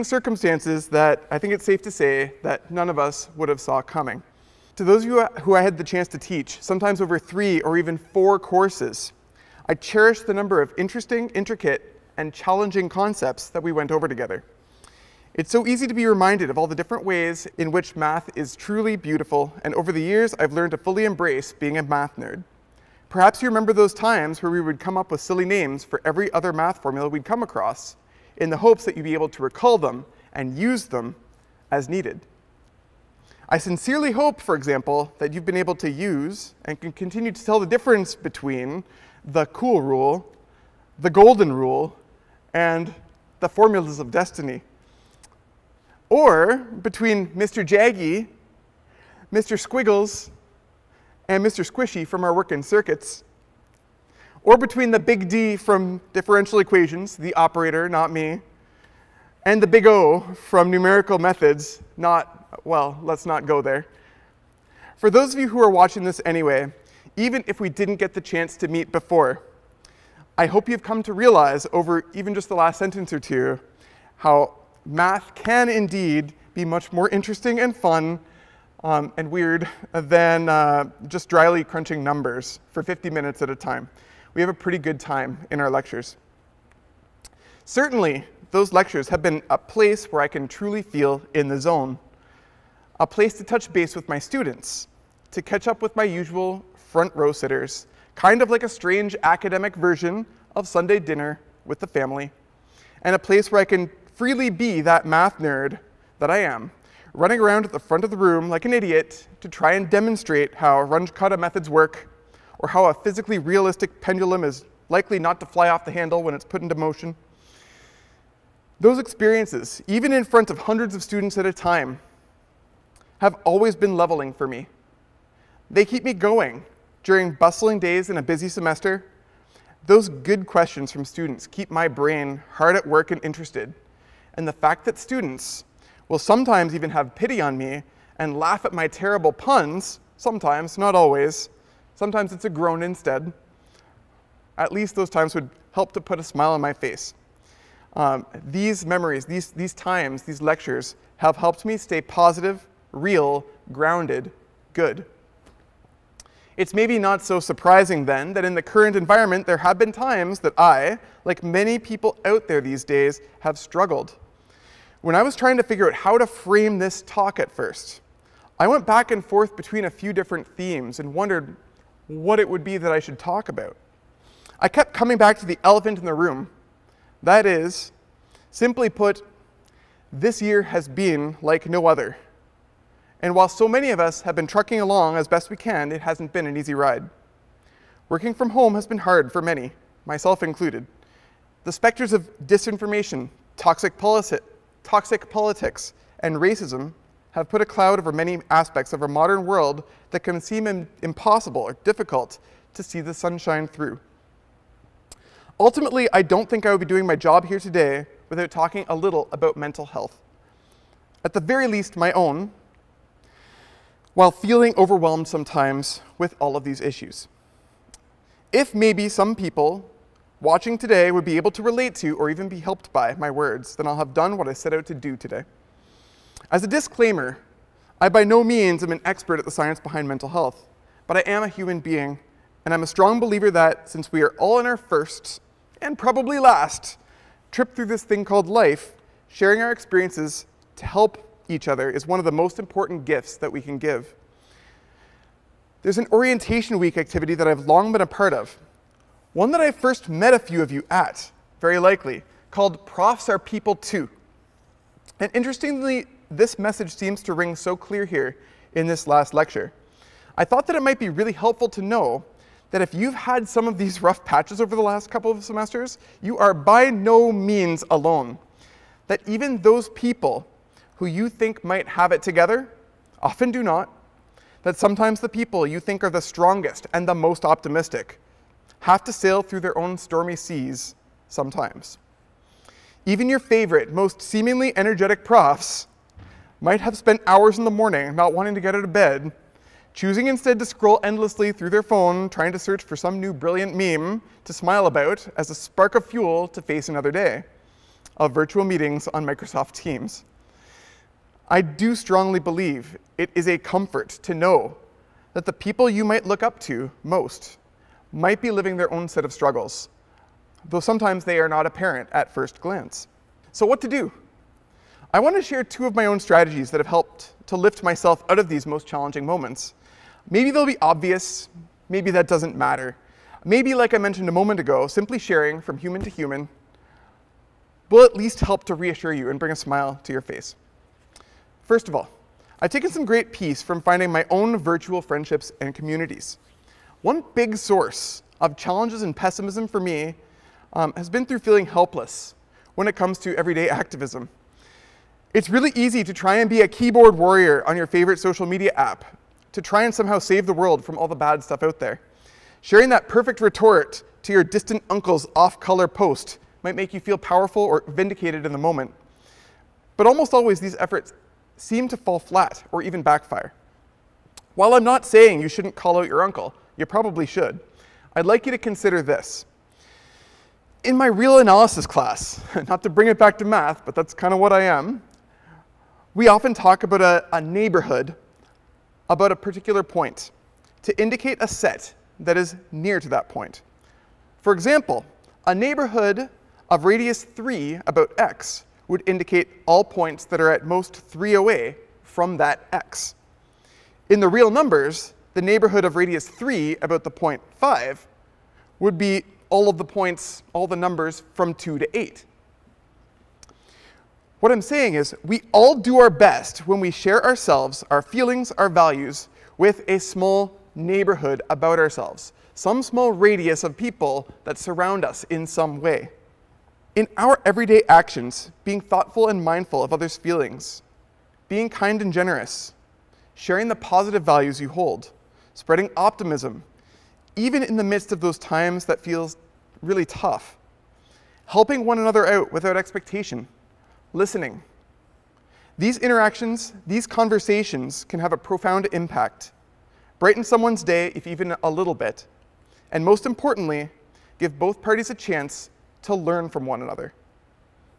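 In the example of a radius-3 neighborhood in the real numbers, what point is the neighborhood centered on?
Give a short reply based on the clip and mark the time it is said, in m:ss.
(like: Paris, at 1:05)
5, at 6:37.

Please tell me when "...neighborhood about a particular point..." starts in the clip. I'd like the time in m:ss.
6:17.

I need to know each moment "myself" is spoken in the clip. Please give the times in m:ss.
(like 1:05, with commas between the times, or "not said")
3:10, 5:17.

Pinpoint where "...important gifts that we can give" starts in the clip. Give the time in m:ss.
4:02.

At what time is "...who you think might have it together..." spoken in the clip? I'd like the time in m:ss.
4:30.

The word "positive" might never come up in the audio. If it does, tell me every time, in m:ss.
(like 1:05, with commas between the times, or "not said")
2:32, 7:03.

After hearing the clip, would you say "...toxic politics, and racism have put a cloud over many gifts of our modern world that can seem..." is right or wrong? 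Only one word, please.
wrong.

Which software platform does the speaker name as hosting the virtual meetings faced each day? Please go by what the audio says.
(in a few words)
Microsoft Teams.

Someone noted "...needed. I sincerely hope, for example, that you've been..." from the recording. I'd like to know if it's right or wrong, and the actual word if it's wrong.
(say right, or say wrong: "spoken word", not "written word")
right.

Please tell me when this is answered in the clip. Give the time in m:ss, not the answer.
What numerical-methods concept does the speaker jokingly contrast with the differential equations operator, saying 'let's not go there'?
0:59.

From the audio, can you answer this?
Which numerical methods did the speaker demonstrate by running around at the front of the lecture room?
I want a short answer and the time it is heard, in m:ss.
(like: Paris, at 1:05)
Runge-Kutta methods, at 1:50.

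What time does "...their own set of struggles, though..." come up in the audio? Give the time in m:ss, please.
5:08.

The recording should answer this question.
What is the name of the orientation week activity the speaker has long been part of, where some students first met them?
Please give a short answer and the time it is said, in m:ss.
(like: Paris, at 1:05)
Profs Are People Too, at 4:12.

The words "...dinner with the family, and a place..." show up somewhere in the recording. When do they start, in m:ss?
1:40.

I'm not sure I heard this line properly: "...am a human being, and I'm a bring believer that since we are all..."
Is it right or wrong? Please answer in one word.
wrong.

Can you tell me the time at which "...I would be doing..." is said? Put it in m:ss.
3:26.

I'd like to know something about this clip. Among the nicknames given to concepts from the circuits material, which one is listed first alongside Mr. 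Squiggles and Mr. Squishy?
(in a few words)
Mr. Jaggy.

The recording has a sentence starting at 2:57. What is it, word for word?
That is, simply put, this year has been like no other.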